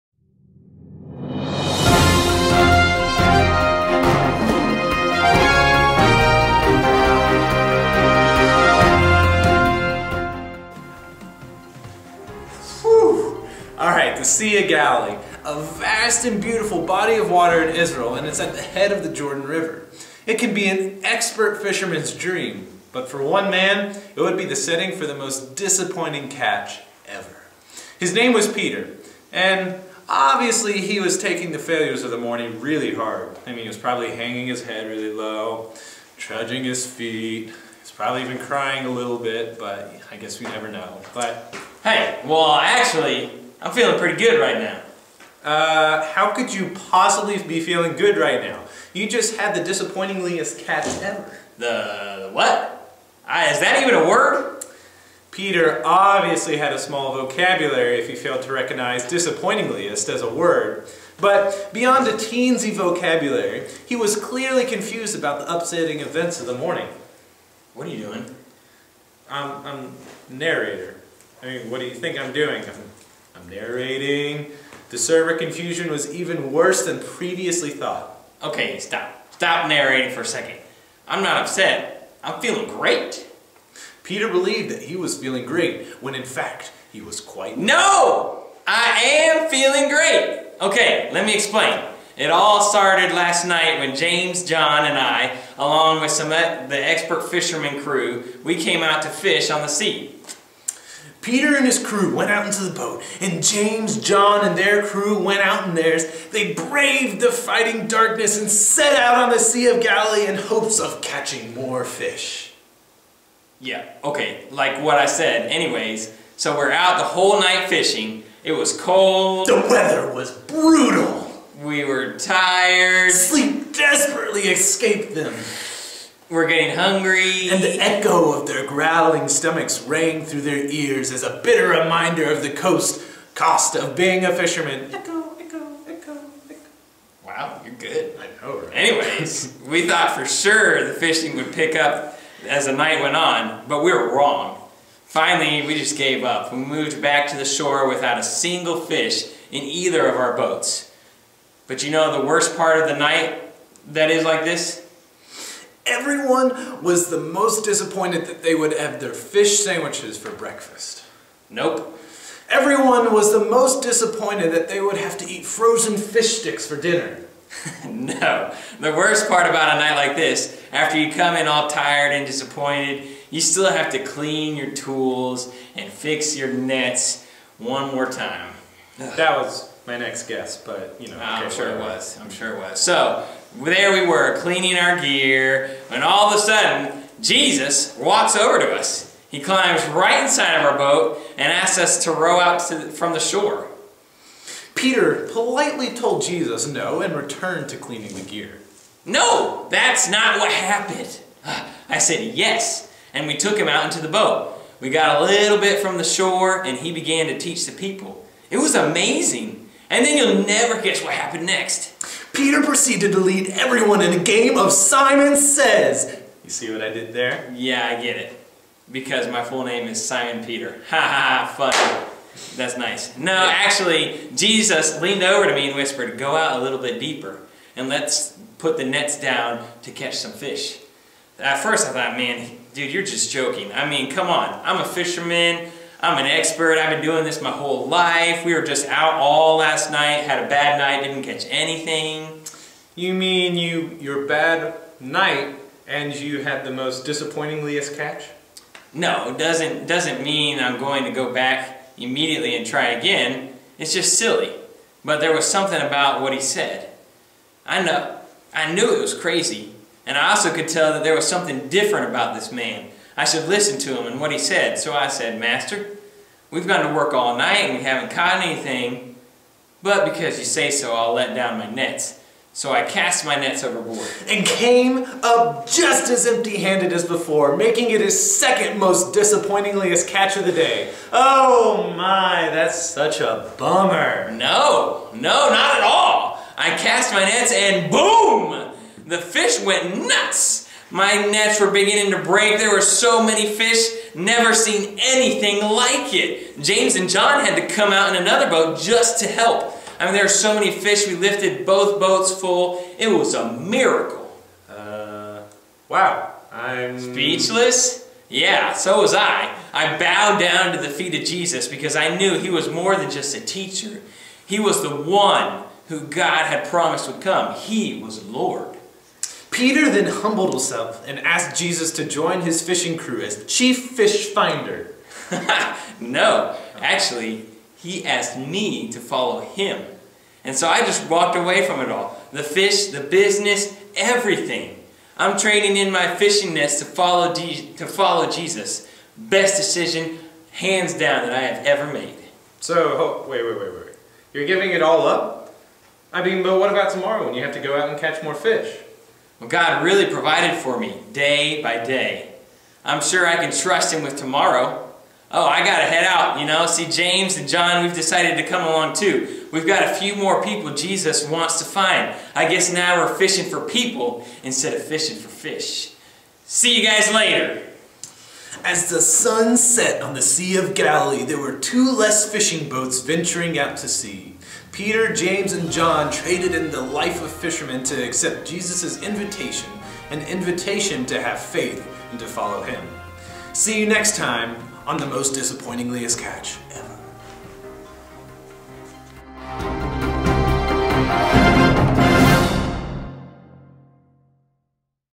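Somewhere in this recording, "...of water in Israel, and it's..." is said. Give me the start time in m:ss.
0:17.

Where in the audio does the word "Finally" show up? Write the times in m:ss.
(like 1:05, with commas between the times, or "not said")
2:25.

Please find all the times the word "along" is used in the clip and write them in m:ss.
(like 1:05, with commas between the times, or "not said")
1:35, 5:58.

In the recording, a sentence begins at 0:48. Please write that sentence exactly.
You just had the disappointingliest catch ever.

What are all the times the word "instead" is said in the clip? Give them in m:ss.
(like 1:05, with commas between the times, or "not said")
6:04.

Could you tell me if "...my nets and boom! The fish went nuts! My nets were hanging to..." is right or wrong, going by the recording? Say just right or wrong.
wrong.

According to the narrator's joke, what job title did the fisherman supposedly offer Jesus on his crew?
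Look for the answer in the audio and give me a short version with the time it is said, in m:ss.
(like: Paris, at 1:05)
Chief fish finder, at 5:23.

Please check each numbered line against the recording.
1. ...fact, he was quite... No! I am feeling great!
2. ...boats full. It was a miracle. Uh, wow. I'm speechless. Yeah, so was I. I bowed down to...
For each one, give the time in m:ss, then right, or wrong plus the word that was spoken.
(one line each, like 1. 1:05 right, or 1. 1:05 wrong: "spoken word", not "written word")
1. 1:26 right
2. 5:01 right.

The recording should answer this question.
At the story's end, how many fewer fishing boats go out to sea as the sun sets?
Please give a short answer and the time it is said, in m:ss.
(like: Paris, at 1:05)
2, at 6:11.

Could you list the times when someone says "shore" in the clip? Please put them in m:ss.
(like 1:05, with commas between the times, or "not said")
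2:27, 3:13, 3:26.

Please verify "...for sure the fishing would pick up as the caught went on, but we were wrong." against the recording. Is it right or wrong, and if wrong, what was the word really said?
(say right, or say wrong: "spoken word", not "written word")
wrong: "night", not "caught".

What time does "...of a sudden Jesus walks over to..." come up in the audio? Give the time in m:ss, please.
3:06.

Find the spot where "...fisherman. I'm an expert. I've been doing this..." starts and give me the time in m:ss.
3:54.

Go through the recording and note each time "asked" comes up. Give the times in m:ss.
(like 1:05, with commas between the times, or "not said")
5:21, 5:28.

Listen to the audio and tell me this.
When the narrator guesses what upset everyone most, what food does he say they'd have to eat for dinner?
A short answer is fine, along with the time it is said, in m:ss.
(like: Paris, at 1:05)
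Frozen fish sticks, at 2:45.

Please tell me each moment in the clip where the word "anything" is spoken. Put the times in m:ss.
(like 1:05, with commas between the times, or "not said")
4:01, 4:28, 4:55.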